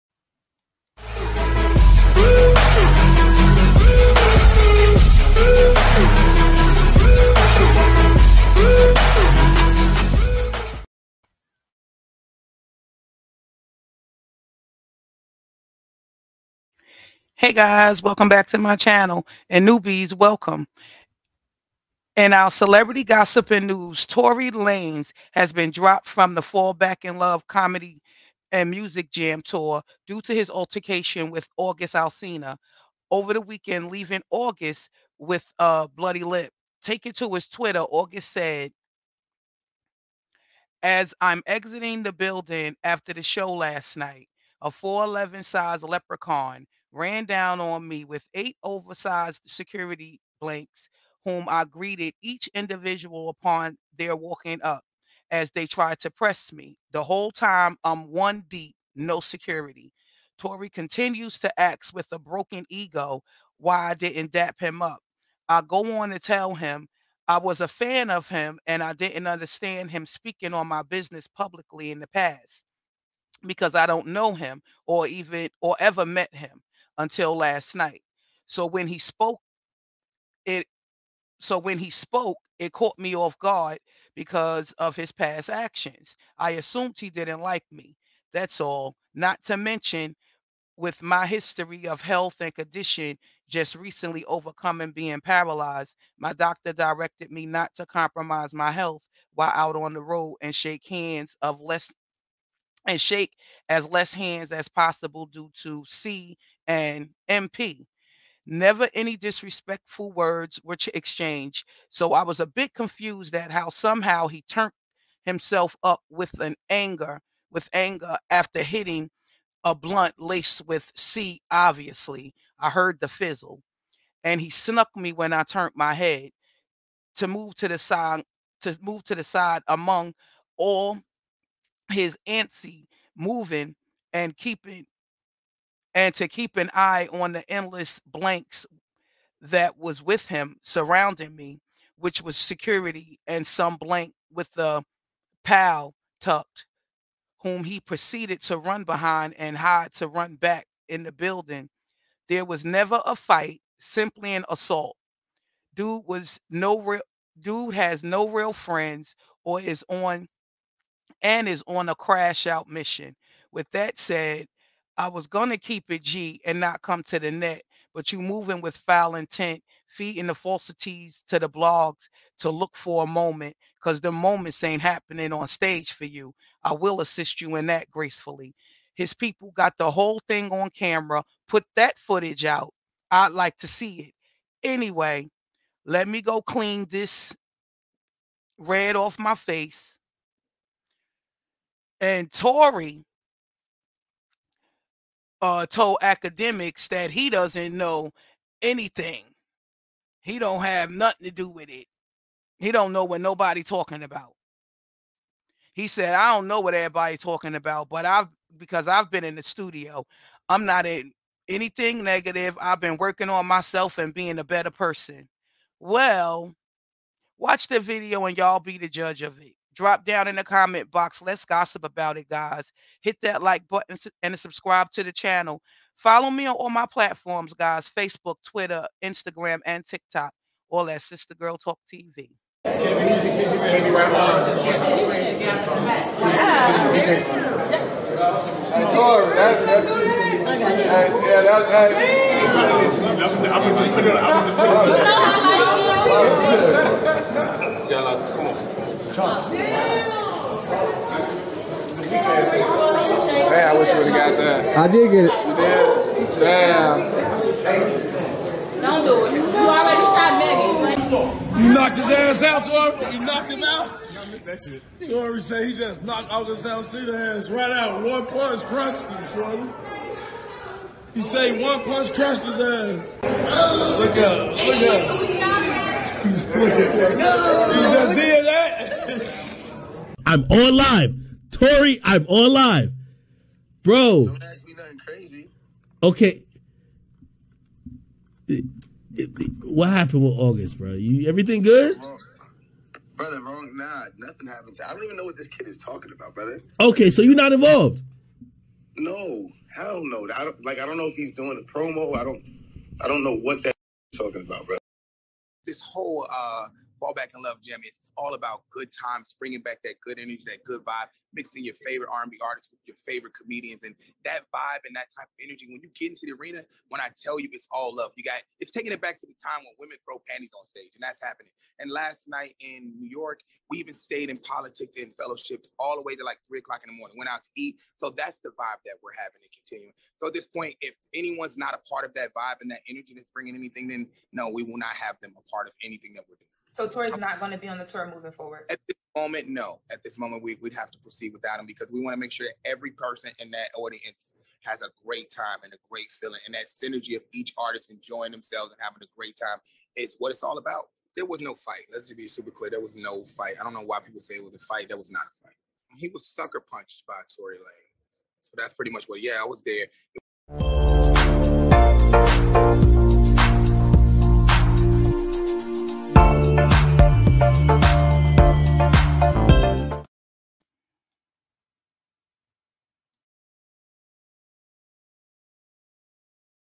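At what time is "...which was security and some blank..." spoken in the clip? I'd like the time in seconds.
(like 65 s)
141 s.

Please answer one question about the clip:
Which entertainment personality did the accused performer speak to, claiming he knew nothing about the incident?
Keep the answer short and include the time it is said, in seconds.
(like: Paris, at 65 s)
Akademiks, at 196 s.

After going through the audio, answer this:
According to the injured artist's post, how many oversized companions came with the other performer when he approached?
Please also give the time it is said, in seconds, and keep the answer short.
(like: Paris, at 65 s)
8, at 48 s.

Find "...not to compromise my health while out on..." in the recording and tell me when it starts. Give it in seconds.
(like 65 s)
97 s.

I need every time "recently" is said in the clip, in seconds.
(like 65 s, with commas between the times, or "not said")
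93 s.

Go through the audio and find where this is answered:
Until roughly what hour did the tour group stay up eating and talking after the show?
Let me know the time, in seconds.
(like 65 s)
326 s.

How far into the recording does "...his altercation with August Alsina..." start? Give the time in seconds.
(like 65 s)
30 s.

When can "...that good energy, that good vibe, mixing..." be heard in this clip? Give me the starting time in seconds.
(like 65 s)
309 s.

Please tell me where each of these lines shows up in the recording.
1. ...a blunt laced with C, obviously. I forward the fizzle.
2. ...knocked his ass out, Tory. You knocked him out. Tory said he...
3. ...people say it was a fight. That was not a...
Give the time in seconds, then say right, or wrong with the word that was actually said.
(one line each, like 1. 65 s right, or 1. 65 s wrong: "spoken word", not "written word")
1. 119 s wrong: "heard", not "forward"
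2. 261 s right
3. 353 s right.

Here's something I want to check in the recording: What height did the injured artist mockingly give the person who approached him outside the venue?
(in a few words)
4'11.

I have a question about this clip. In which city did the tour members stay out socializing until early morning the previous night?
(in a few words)
New York.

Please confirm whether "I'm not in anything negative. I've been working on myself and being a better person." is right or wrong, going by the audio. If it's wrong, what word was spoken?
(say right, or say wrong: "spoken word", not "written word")
right.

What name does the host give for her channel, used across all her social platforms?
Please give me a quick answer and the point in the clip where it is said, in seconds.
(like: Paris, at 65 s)
Sister Girl Talk TV, at 231 s.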